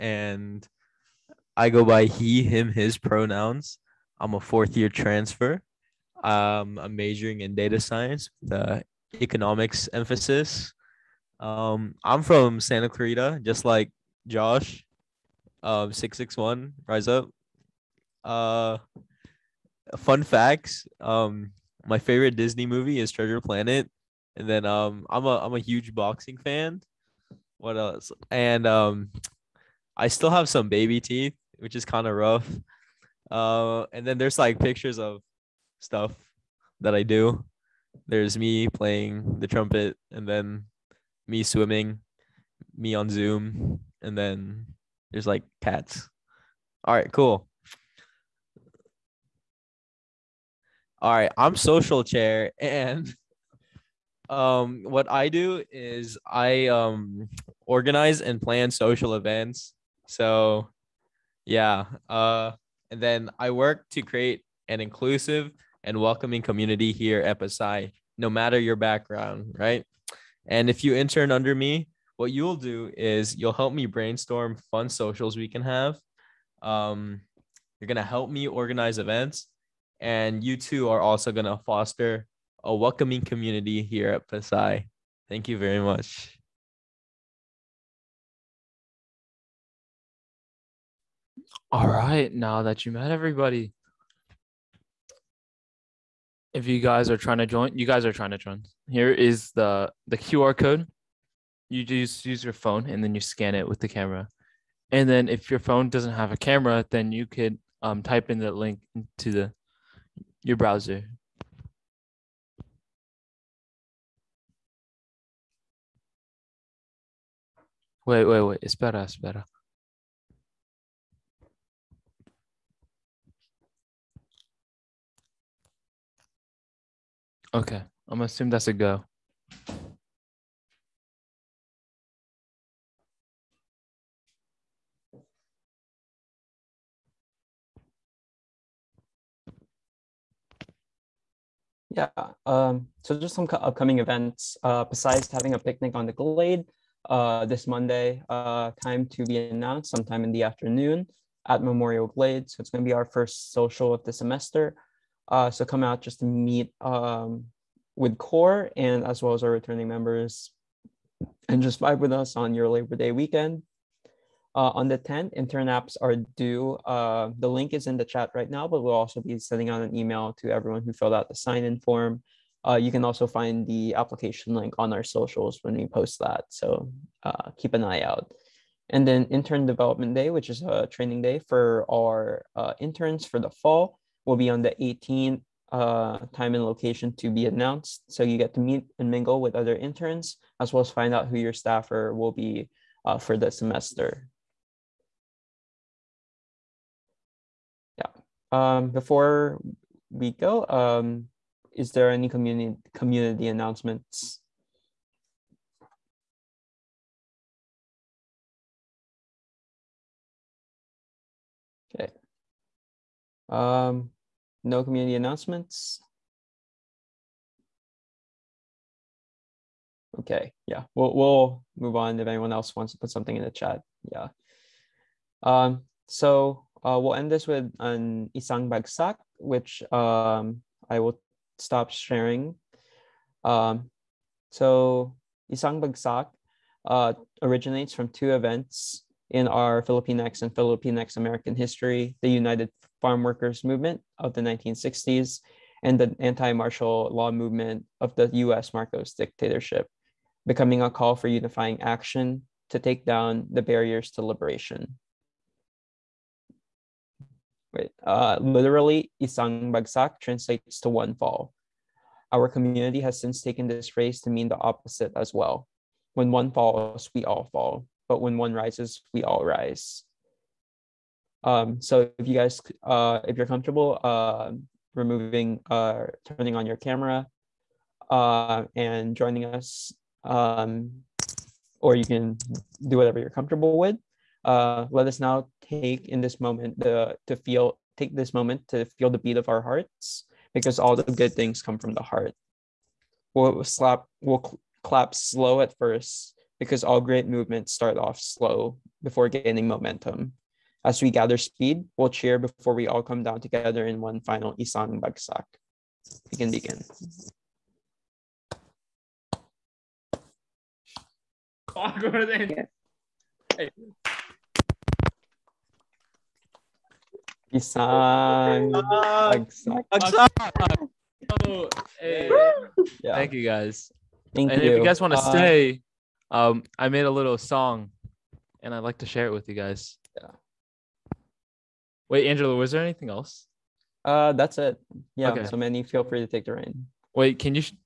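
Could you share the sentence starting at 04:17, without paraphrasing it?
Wait, uh, literally, isang bagsak translates to one fall.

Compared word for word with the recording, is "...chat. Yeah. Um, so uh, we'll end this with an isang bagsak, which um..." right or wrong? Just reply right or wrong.
right.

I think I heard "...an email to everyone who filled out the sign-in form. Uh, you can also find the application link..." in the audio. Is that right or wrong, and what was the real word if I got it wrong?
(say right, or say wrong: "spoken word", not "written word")
right.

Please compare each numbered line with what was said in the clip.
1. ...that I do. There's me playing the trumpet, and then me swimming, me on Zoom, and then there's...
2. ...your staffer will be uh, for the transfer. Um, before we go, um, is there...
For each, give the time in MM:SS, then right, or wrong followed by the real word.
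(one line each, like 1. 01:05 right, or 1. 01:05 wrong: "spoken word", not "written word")
1. 00:36 right
2. 03:11 wrong: "semester", not "transfer".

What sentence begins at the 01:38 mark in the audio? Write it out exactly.
Here is the the QR code you just use your phone and then you scan it with the camera.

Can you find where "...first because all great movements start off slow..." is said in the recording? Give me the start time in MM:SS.
04:55.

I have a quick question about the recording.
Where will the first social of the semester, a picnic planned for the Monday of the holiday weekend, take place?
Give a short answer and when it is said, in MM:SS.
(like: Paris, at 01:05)
Memorial Glade, at 02:31.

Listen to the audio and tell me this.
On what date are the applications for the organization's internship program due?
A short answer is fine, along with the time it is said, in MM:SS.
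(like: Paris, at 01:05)
the 10th, at 02:44.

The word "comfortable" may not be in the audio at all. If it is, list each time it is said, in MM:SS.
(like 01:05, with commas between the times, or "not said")
04:33, 04:43.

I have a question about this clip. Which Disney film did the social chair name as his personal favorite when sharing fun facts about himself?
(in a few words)
Treasure Planet.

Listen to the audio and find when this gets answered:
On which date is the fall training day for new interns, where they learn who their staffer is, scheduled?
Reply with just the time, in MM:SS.
03:04.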